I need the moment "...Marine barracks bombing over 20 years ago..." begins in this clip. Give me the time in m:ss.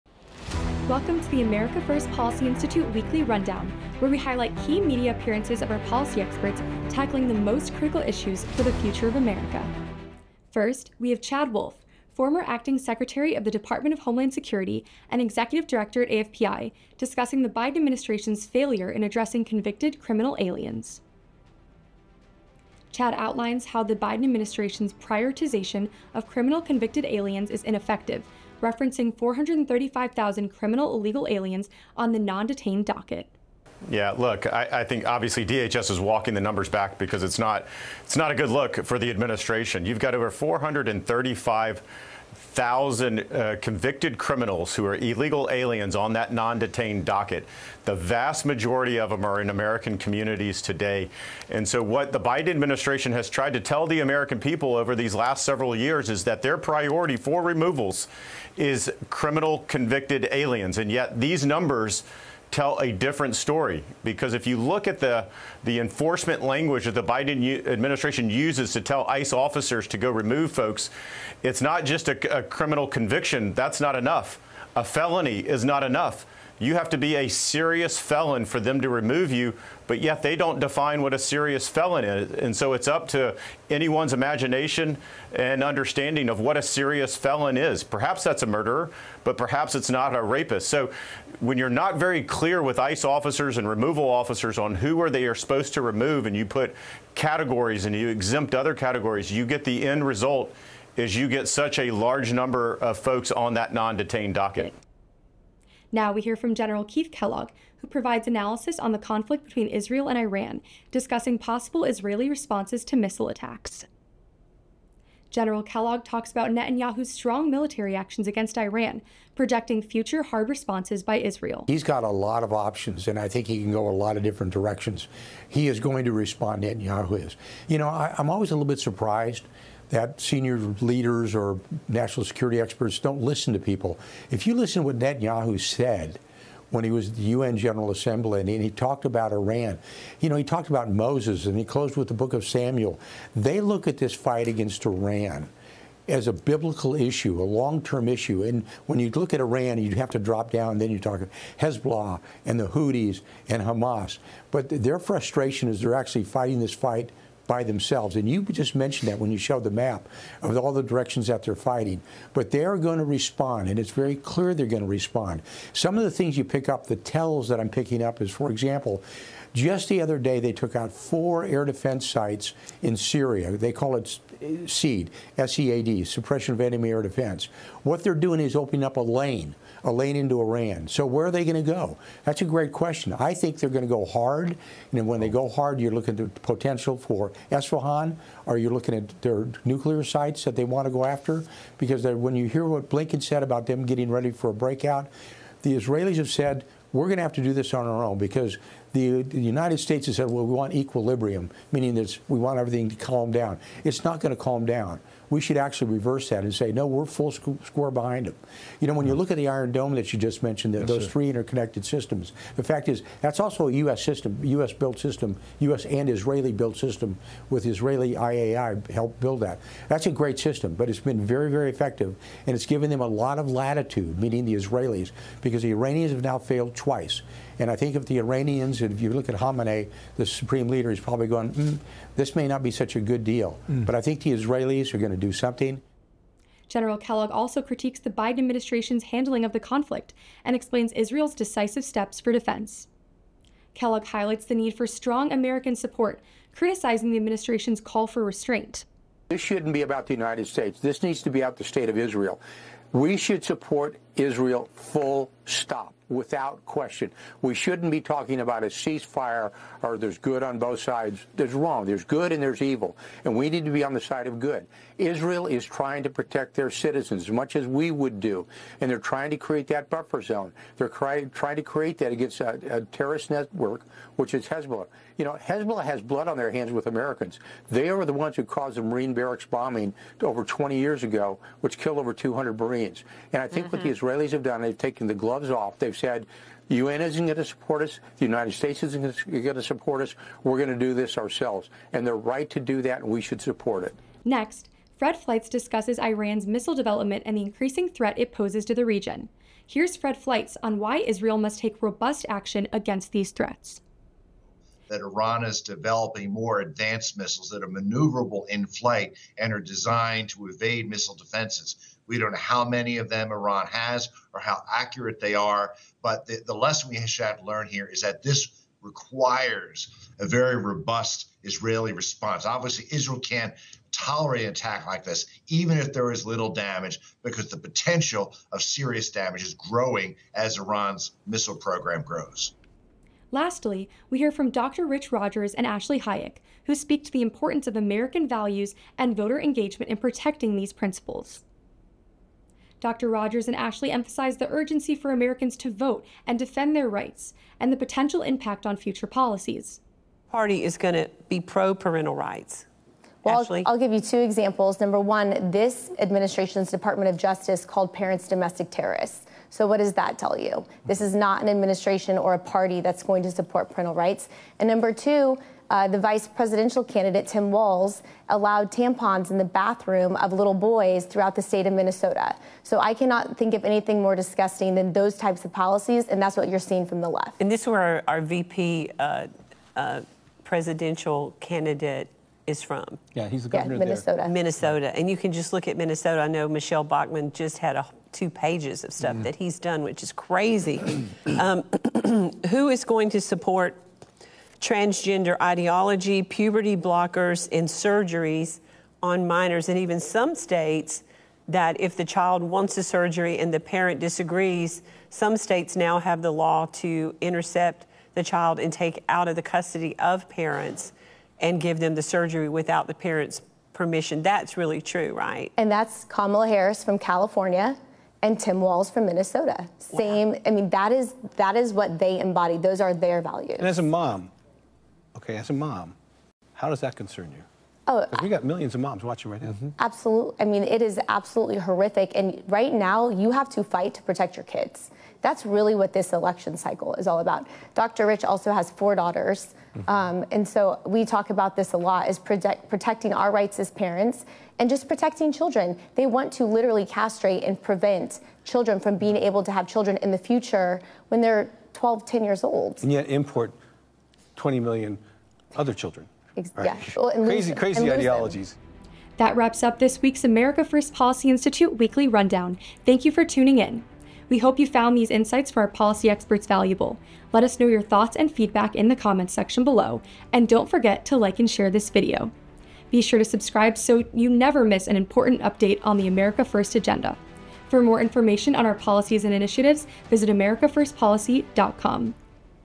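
4:38.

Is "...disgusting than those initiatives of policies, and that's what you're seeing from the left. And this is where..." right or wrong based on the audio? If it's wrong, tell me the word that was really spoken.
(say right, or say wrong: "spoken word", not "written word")
wrong: "types", not "initiatives".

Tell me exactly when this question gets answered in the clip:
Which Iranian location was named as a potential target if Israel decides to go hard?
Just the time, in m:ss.
3:07.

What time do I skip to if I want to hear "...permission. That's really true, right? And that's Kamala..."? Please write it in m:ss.
6:53.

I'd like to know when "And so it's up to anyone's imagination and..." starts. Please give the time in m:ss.
1:22.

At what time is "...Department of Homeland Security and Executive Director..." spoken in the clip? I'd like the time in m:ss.
0:13.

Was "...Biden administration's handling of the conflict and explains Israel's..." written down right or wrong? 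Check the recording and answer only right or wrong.
right.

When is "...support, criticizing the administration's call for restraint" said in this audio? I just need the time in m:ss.
4:05.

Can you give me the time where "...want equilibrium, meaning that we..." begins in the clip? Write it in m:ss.
3:20.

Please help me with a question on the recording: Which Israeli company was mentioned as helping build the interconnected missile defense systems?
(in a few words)
IAI.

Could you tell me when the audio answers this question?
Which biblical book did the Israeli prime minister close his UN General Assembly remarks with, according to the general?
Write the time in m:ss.
2:22.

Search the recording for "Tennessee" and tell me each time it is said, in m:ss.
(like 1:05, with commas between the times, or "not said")
not said.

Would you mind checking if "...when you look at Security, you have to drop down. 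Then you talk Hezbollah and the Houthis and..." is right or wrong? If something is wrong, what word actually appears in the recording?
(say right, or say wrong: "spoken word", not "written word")
wrong: "Iran", not "Security".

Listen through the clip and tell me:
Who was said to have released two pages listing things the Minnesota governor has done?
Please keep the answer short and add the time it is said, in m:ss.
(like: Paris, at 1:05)
Michelle Bachmann, at 6:26.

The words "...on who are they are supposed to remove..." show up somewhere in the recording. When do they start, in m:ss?
1:34.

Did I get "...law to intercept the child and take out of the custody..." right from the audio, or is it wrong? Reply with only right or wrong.
right.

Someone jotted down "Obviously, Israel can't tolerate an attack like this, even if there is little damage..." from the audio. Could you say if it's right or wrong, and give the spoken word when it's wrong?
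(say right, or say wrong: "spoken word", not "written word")
right.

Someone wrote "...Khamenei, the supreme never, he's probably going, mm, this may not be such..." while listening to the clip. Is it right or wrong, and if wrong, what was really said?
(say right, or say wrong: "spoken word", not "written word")
wrong: "leader", not "never".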